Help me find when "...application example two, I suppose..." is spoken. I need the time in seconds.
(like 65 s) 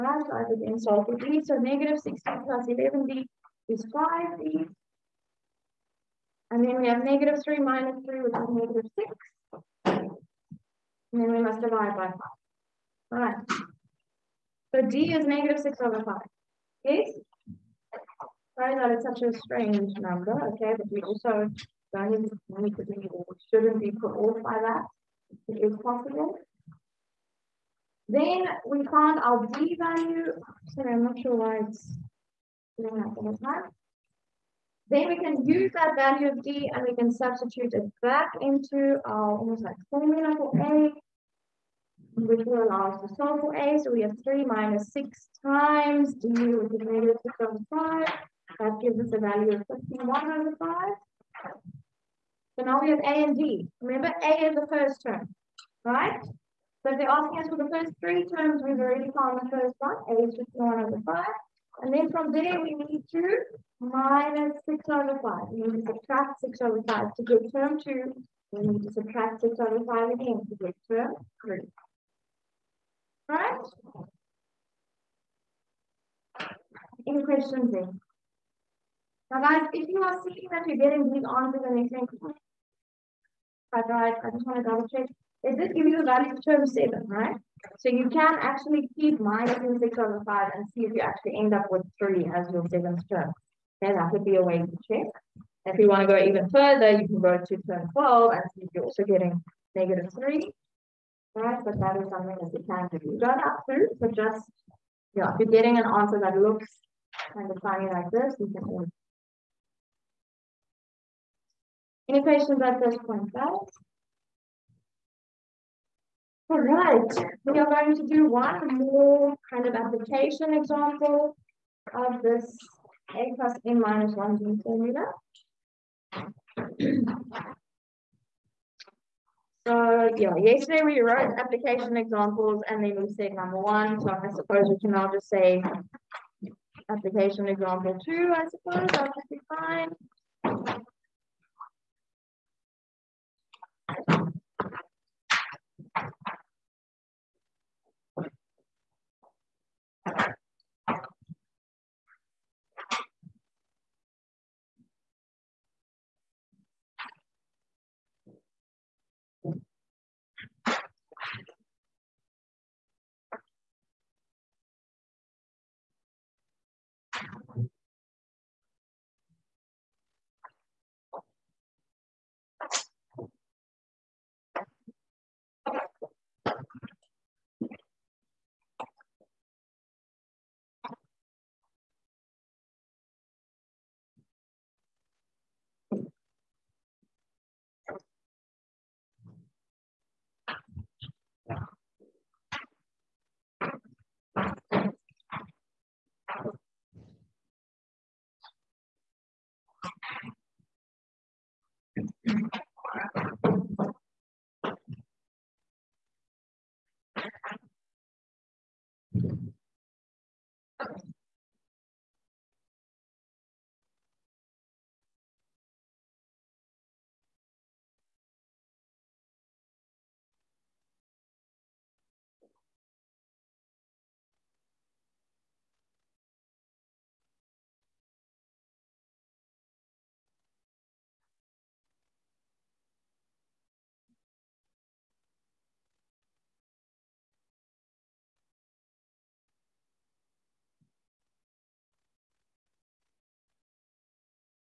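136 s.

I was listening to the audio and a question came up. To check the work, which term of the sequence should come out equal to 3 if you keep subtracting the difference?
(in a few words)
7th term.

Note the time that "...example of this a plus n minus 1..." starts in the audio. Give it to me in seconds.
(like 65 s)
120 s.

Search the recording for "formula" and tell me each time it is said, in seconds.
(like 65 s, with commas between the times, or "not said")
39 s, 124 s.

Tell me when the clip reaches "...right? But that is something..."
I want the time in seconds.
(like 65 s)
101 s.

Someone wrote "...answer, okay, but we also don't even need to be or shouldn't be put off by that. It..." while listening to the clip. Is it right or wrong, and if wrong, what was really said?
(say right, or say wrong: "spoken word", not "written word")
wrong: "number", not "answer".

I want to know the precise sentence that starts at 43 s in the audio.
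So we have 3 minus 6 times d, which is negative five.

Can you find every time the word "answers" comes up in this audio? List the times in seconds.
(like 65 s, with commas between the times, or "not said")
81 s, 105 s.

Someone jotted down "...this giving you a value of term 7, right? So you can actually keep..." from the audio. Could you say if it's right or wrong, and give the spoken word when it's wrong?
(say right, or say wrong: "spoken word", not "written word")
right.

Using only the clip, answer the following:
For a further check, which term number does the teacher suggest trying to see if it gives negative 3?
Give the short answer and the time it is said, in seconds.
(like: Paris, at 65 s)
12, at 97 s.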